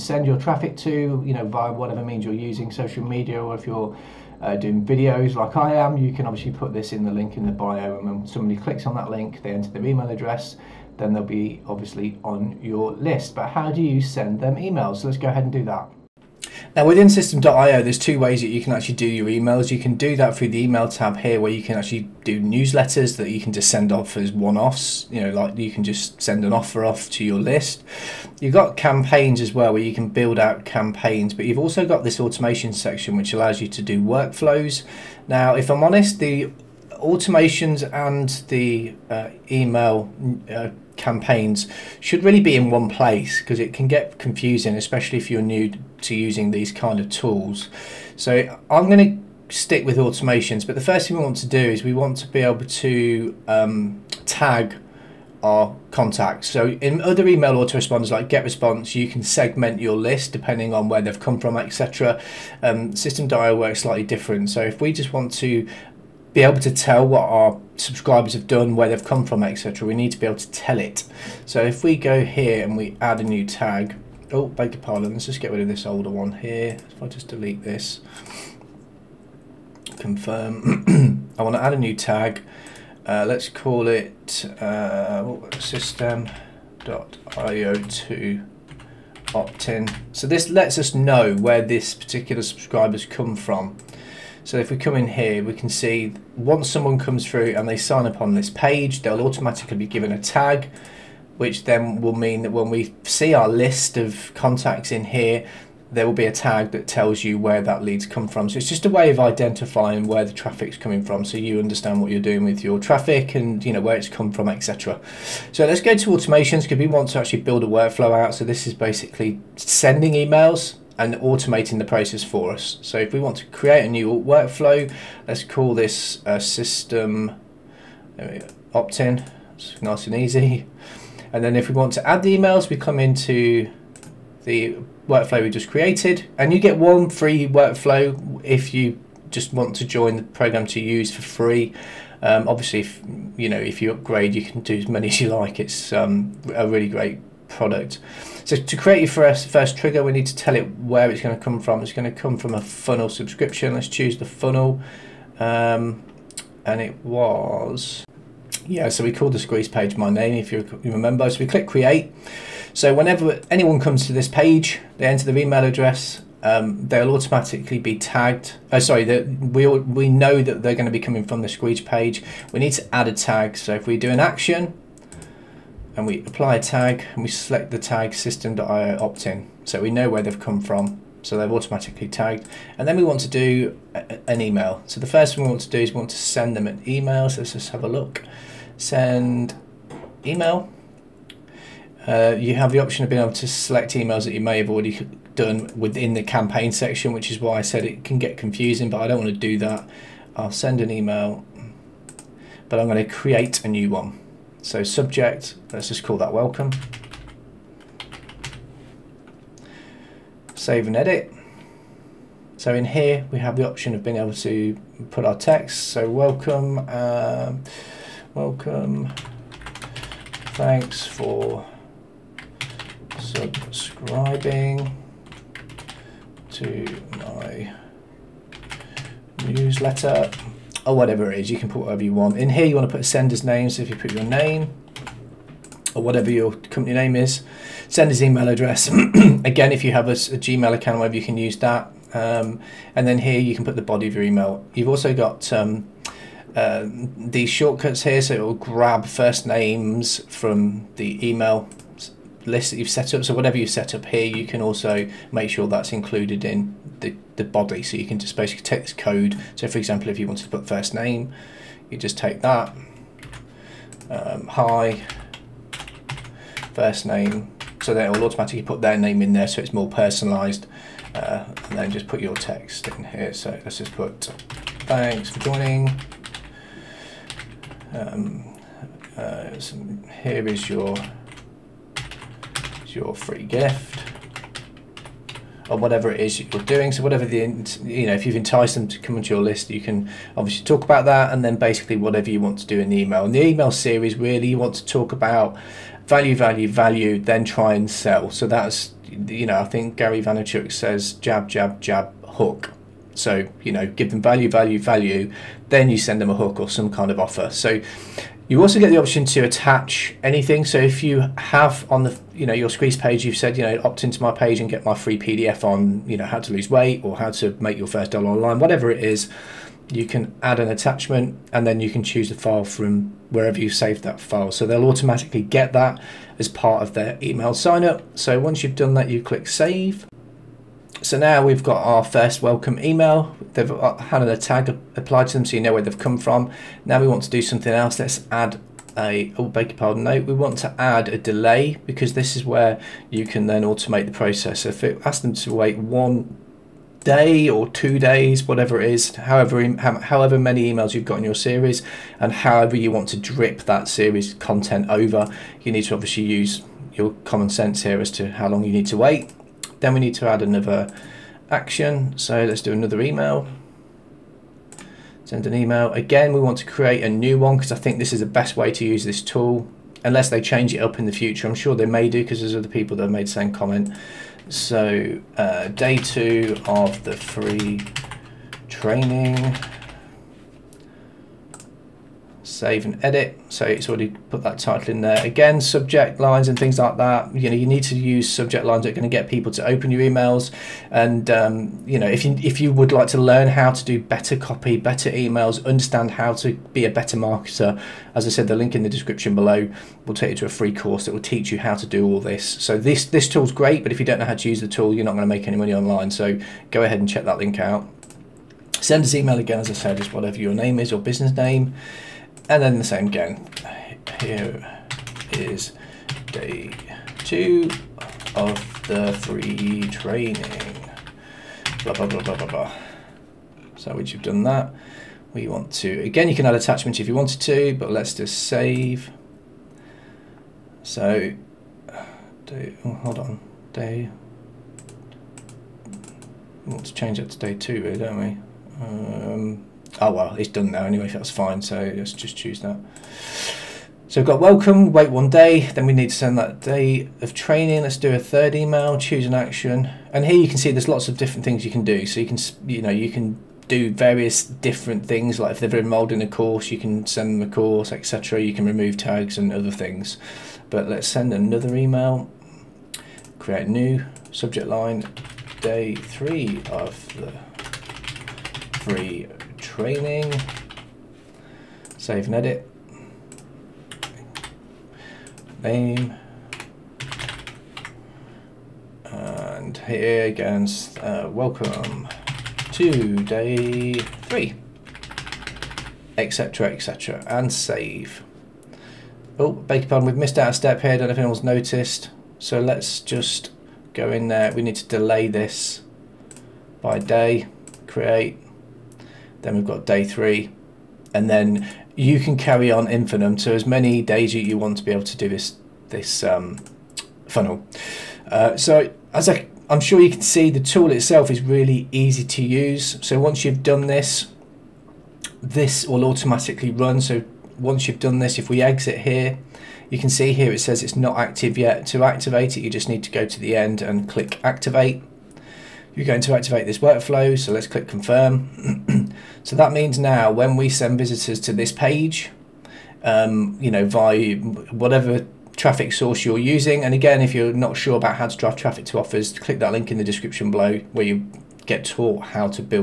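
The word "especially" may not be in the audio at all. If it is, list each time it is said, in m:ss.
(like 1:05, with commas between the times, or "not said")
0:44.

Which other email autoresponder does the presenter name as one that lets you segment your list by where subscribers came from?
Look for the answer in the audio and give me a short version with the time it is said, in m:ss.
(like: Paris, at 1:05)
GetResponse, at 0:58.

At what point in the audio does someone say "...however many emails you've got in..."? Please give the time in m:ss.
5:50.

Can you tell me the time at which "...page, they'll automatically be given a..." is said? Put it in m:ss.
1:38.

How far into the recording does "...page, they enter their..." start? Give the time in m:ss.
2:44.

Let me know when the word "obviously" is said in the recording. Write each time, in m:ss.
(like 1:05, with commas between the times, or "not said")
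0:06, 0:11, 2:22, 4:50, 5:55.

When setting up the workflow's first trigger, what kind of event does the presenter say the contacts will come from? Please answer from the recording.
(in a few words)
A funnel subscription.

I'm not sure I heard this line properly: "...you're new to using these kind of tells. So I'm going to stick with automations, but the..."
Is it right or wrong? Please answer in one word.
wrong.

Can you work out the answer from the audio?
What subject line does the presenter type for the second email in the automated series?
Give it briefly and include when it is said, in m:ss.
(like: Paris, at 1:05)
Day two of the free training, at 6:15.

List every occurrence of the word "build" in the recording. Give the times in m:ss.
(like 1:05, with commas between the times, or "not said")
0:30, 1:57.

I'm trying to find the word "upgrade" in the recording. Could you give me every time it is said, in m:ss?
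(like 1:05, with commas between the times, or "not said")
2:23.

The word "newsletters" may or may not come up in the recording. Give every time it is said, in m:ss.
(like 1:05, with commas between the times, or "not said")
0:22, 3:49.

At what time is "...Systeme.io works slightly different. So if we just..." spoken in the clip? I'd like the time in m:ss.
1:02.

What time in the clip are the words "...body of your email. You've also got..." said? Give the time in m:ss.
4:03.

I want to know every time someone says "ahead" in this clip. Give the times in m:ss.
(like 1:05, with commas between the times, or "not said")
0:15, 6:46.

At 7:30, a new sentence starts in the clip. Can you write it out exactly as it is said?
And here you can see there's lots of different things you can do.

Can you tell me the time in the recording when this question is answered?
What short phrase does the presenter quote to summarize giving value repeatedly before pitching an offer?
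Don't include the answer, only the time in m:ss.
5:01.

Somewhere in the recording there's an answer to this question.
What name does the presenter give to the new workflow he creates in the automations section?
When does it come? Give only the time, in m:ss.
2:06.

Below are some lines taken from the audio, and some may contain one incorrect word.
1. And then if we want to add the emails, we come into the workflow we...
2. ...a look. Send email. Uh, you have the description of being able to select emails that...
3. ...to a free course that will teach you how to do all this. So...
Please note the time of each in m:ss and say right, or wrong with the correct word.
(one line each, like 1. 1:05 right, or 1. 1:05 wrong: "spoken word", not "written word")
1. 2:11 right
2. 3:07 wrong: "option", not "description"
3. 6:40 right.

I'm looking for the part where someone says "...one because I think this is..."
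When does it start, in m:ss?
6:07.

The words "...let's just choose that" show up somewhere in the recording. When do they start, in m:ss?
7:21.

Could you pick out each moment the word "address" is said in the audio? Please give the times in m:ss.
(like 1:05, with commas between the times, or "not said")
0:10, 2:45, 3:58.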